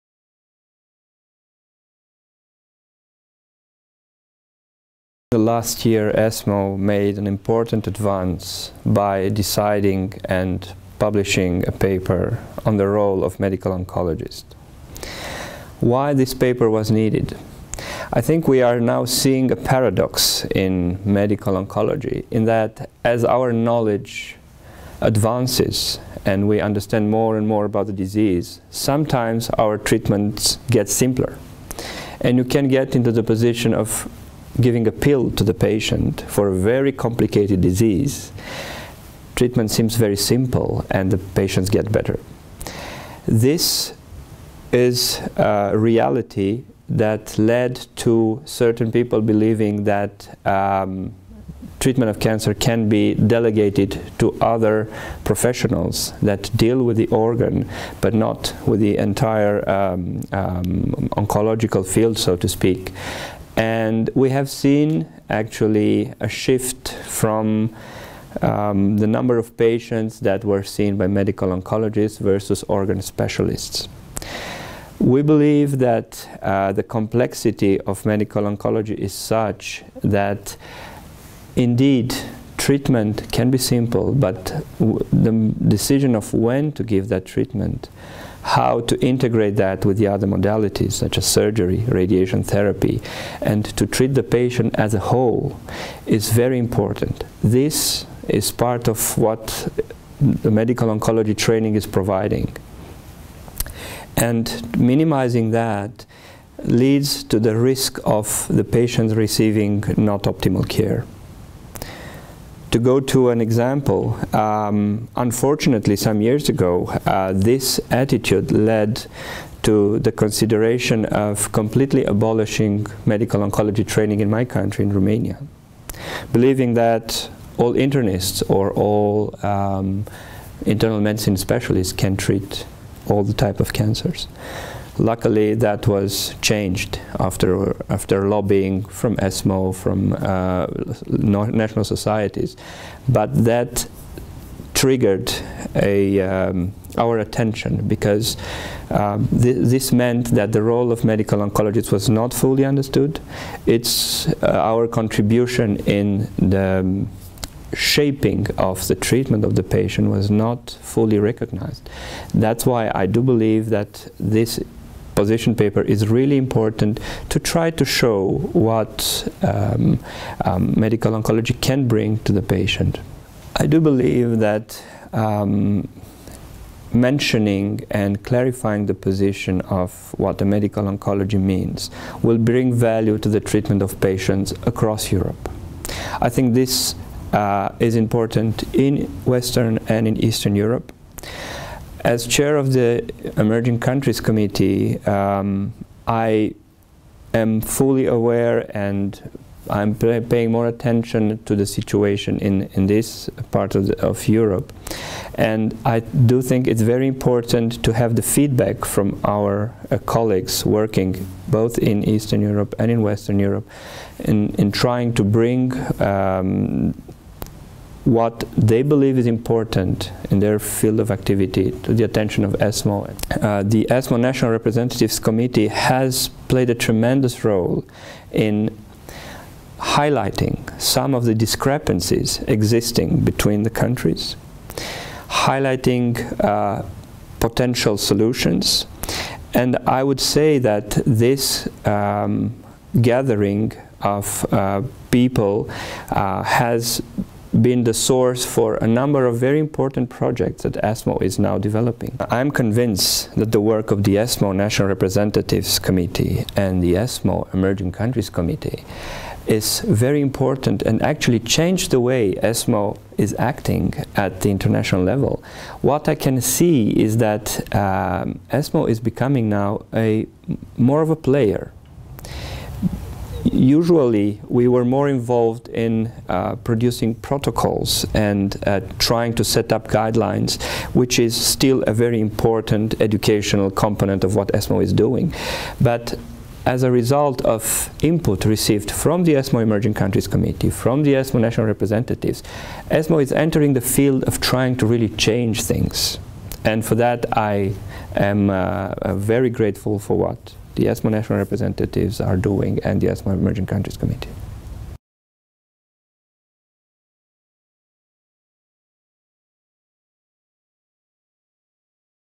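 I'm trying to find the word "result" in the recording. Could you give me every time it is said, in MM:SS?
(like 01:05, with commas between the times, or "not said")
04:46.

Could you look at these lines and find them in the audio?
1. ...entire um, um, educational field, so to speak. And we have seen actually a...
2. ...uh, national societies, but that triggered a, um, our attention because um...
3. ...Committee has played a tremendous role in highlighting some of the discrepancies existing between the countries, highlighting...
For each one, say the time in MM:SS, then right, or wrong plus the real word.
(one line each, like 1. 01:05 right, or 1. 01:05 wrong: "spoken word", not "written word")
1. 00:58 wrong: "oncological", not "educational"
2. 02:20 right
3. 03:45 right.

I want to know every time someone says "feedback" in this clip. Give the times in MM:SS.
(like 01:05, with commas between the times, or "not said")
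03:28.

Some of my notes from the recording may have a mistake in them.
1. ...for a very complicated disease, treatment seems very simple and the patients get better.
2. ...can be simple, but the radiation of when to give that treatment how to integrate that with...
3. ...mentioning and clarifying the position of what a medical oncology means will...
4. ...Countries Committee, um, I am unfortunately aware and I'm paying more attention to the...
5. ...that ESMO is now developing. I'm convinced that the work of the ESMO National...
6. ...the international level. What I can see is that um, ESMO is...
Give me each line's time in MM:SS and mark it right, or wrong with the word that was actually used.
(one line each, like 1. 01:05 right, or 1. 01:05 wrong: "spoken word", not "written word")
1. 00:36 right
2. 01:23 wrong: "decision", not "radiation"
3. 02:57 right
4. 03:13 wrong: "fully", not "unfortunately"
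5. 04:10 right
6. 04:24 right.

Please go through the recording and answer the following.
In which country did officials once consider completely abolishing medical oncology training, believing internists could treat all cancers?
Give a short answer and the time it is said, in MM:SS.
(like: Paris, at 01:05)
Romania, at 02:04.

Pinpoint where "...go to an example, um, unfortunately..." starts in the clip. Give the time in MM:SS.
01:52.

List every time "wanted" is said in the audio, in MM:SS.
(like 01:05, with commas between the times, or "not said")
not said.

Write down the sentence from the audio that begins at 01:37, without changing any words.
This is part of what the medical oncology training is providing.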